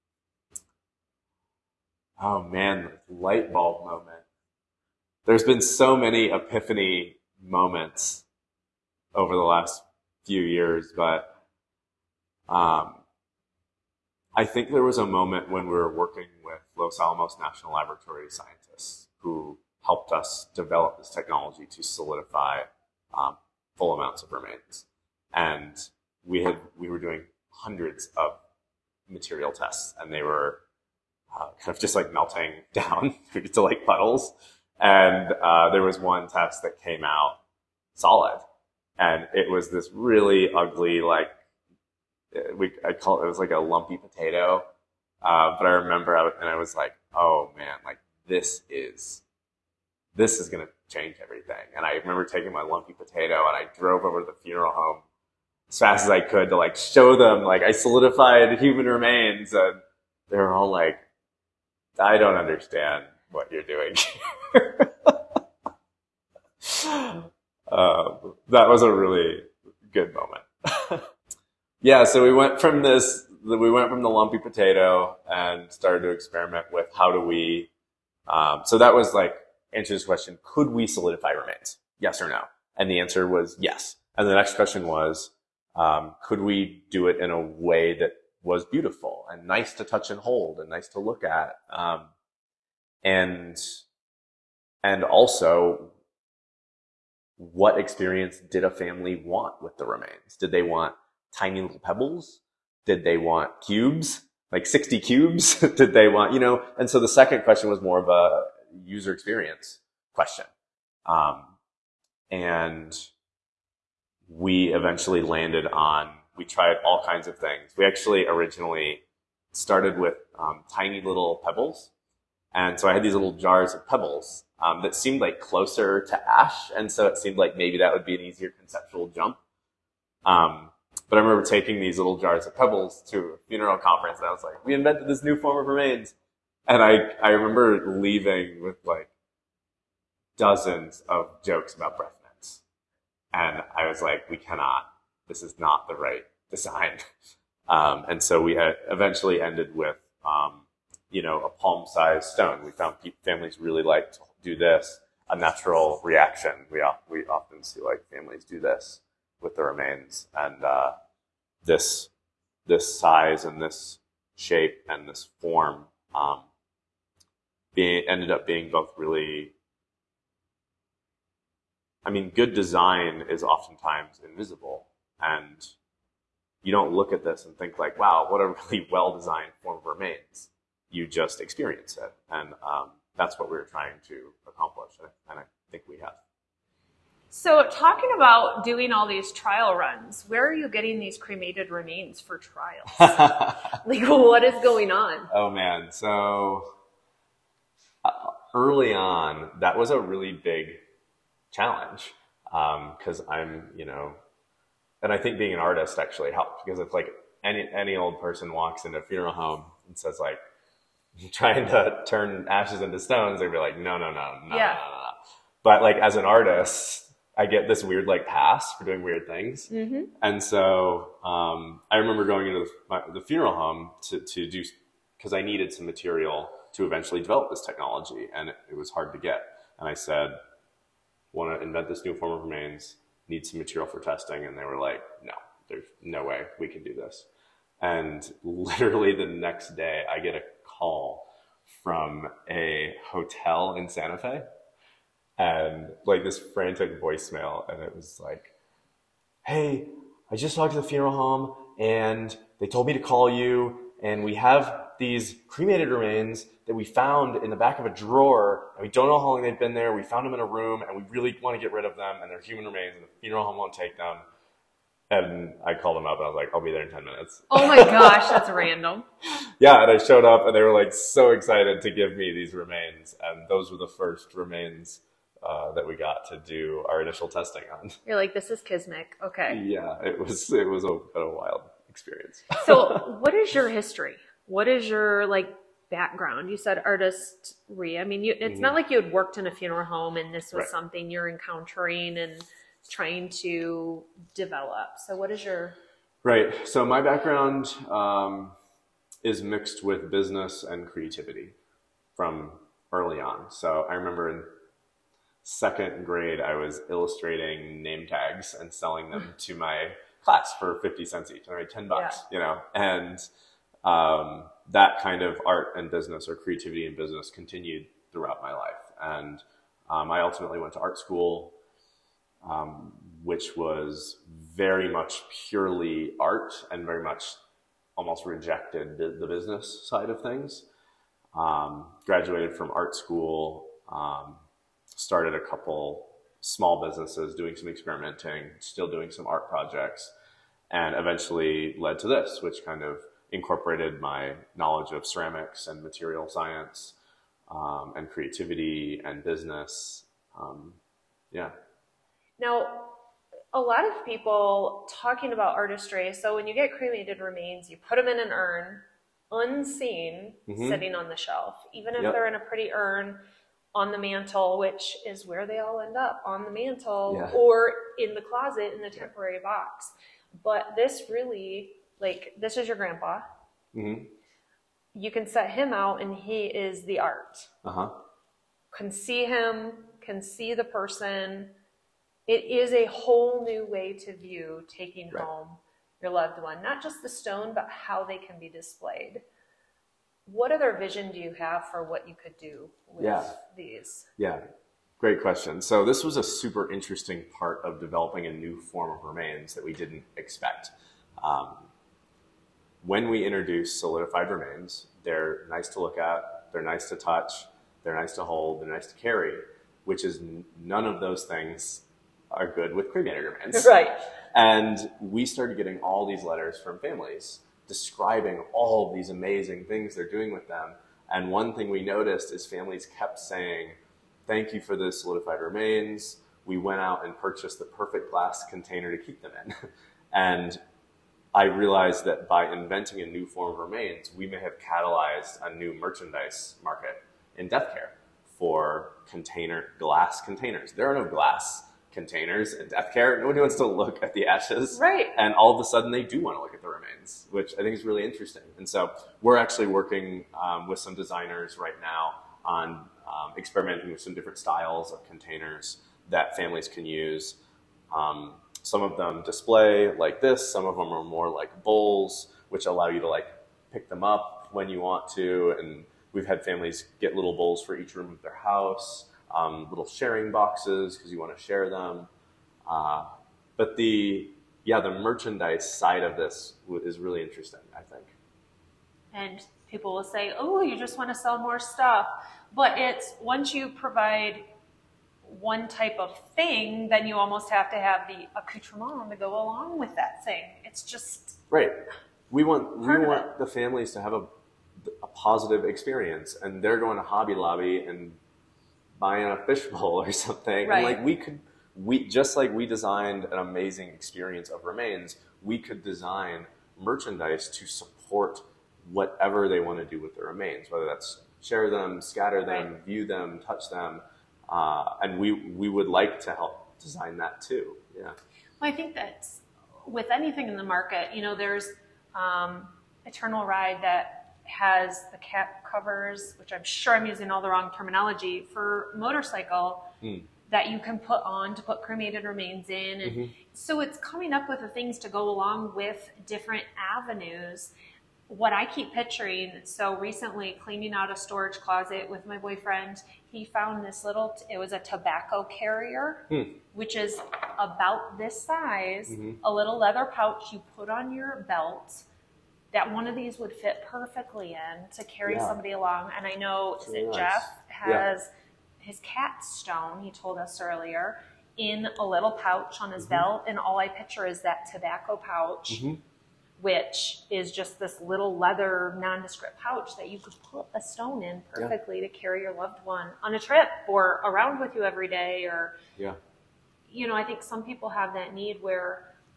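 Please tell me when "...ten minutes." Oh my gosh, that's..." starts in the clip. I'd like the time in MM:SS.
04:26.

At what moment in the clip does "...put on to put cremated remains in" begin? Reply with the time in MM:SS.
08:50.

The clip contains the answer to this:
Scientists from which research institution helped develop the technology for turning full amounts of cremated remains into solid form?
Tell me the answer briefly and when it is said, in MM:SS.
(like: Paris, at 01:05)
Los Alamos National Laboratory, at 00:16.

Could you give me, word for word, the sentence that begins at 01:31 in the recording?
Um, and, and also what experience did a family want with the remains?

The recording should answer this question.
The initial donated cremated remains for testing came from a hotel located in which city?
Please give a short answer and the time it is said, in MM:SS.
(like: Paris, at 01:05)
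Santa Fe, at 04:03.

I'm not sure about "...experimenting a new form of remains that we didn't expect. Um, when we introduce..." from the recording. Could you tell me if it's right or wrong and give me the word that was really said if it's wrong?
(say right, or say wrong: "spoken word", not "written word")
wrong: "developing", not "experimenting".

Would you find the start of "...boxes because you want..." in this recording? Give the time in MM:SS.
07:50.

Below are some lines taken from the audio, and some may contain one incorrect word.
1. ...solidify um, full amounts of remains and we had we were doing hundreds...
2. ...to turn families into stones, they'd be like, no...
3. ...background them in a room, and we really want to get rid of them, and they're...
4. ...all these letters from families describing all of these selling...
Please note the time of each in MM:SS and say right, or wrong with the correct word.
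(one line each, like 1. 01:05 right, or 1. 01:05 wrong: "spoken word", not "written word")
1. 00:21 right
2. 03:31 wrong: "ashes", not "families"
3. 04:20 wrong: "found", not "background"
4. 06:55 wrong: "amazing", not "selling".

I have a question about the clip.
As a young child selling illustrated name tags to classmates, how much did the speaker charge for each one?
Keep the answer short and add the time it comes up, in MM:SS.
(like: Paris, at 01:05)
50 cents, at 05:10.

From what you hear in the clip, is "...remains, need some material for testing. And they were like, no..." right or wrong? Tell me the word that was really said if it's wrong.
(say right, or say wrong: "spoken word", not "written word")
right.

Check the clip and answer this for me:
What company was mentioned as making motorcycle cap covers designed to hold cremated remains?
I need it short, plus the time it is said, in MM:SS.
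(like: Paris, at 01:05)
Eternal Ride, at 08:43.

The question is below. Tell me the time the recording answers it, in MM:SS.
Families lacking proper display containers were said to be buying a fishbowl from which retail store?
08:17.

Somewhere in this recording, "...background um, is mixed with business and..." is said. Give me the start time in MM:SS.
04:56.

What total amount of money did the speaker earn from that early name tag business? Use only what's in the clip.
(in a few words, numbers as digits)
10 dollars.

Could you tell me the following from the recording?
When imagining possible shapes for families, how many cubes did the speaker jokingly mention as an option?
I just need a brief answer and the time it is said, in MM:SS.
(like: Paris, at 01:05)
60, at 01:44.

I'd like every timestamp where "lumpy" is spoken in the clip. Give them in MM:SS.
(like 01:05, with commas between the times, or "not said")
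00:43, 00:52, 01:14.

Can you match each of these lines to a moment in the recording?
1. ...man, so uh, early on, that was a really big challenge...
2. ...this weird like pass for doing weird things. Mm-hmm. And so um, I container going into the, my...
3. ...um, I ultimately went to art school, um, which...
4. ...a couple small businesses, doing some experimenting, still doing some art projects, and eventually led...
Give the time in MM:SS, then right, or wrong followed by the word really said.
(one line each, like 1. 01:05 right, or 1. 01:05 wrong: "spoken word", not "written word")
1. 03:15 right
2. 03:37 wrong: "remember", not "container"
3. 05:19 right
4. 05:35 right.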